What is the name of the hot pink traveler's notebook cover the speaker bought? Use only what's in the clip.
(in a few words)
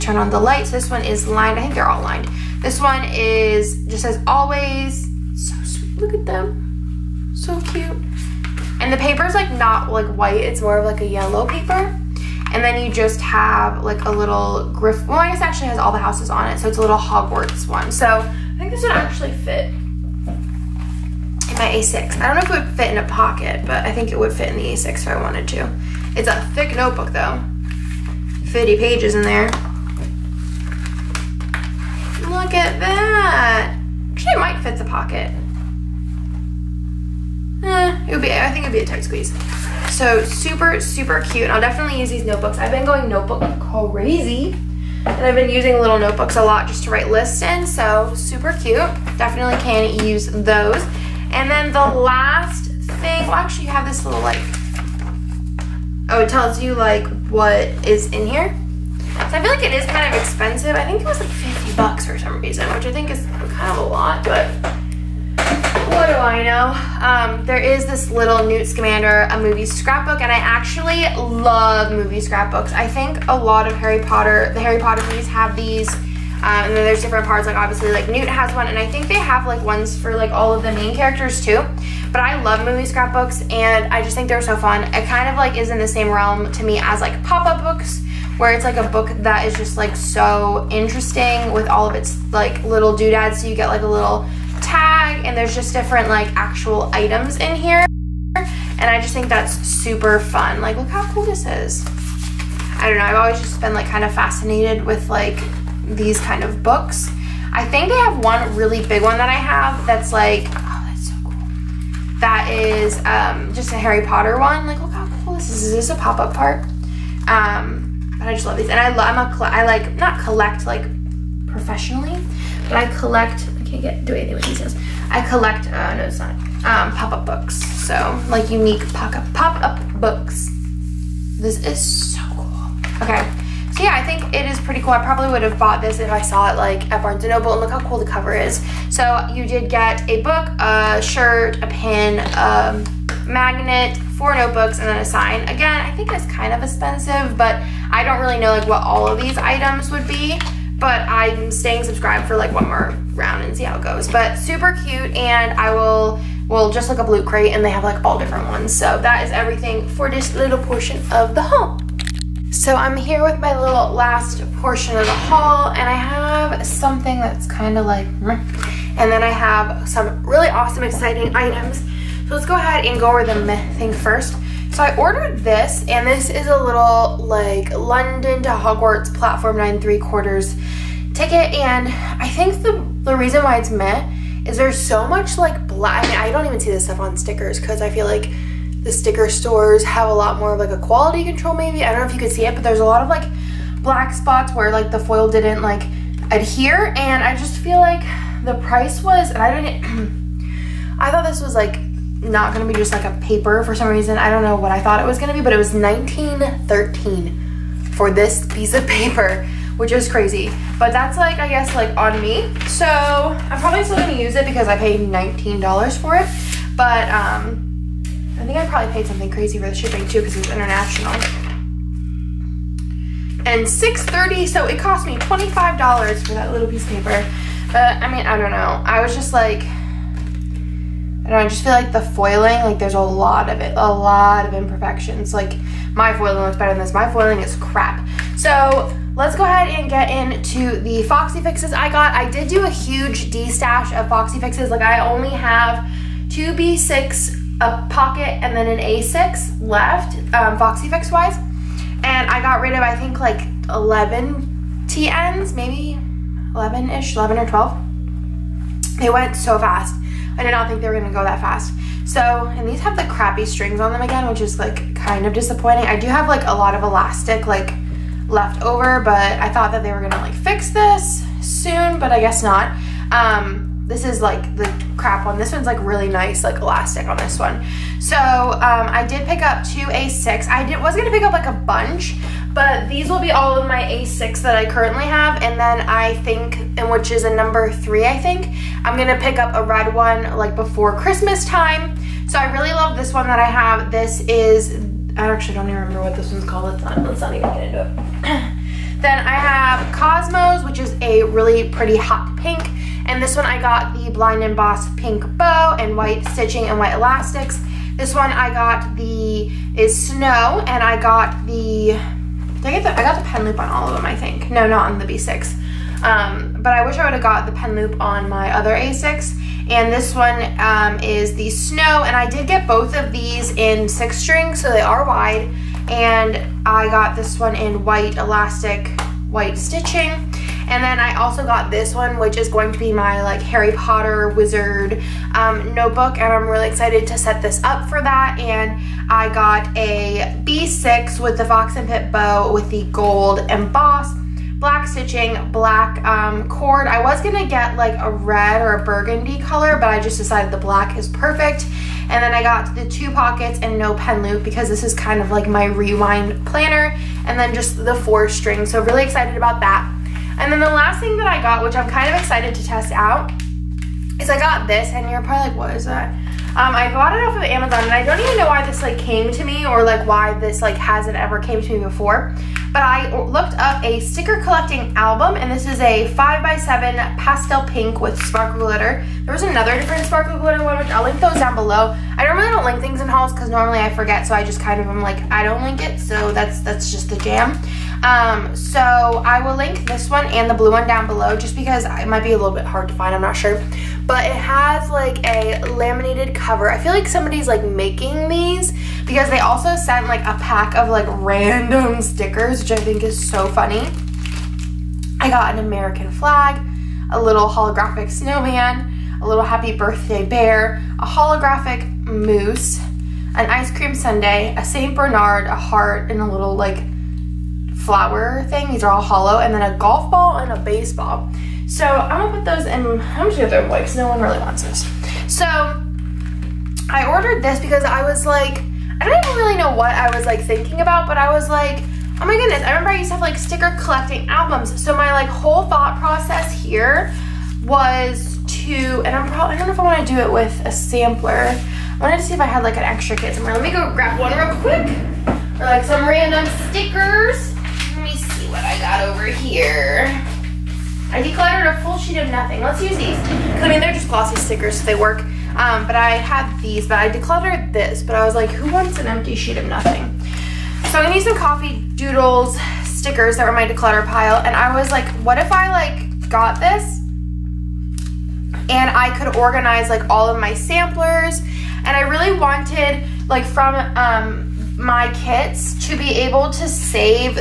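Cosmos.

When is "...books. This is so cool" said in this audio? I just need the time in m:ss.
2:09.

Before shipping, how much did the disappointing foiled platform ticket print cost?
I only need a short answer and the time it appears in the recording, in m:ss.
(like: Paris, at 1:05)
19.13, at 3:25.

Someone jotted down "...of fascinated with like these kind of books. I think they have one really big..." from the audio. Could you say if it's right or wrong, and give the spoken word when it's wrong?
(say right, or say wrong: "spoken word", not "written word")
right.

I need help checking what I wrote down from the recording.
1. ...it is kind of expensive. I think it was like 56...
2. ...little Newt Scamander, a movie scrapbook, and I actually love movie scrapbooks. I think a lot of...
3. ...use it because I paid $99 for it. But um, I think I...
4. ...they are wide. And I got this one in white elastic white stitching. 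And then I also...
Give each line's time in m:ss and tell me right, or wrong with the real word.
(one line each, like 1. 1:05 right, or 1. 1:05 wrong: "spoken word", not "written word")
1. 0:59 wrong: "50", not "56"
2. 1:08 right
3. 3:34 wrong: "19", not "99"
4. 5:24 right.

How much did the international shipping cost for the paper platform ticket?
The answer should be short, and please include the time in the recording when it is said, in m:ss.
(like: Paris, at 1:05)
6.30, at 3:43.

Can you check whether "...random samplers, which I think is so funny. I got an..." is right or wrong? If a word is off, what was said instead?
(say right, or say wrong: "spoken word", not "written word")
wrong: "stickers", not "samplers".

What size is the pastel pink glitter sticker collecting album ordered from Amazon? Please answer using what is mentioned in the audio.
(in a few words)
5x7.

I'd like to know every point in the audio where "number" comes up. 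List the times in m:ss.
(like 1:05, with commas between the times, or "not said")
4:47.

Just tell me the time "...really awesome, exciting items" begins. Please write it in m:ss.
2:50.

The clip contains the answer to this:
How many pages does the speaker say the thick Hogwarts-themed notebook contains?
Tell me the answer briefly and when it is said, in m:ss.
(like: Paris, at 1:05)
50, at 0:27.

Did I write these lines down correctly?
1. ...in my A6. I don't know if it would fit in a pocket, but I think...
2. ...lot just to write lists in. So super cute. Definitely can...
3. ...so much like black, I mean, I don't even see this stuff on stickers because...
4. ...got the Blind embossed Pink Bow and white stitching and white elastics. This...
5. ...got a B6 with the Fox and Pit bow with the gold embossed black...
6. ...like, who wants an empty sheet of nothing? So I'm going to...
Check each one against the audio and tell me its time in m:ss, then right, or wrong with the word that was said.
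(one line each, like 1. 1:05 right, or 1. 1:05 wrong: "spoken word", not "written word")
1. 0:20 right
2. 0:46 right
3. 3:04 right
4. 5:03 right
5. 5:39 right
6. 7:38 right.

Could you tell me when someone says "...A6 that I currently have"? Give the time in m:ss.
4:43.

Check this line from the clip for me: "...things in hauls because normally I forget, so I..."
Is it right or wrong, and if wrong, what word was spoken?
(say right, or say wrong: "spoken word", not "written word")
right.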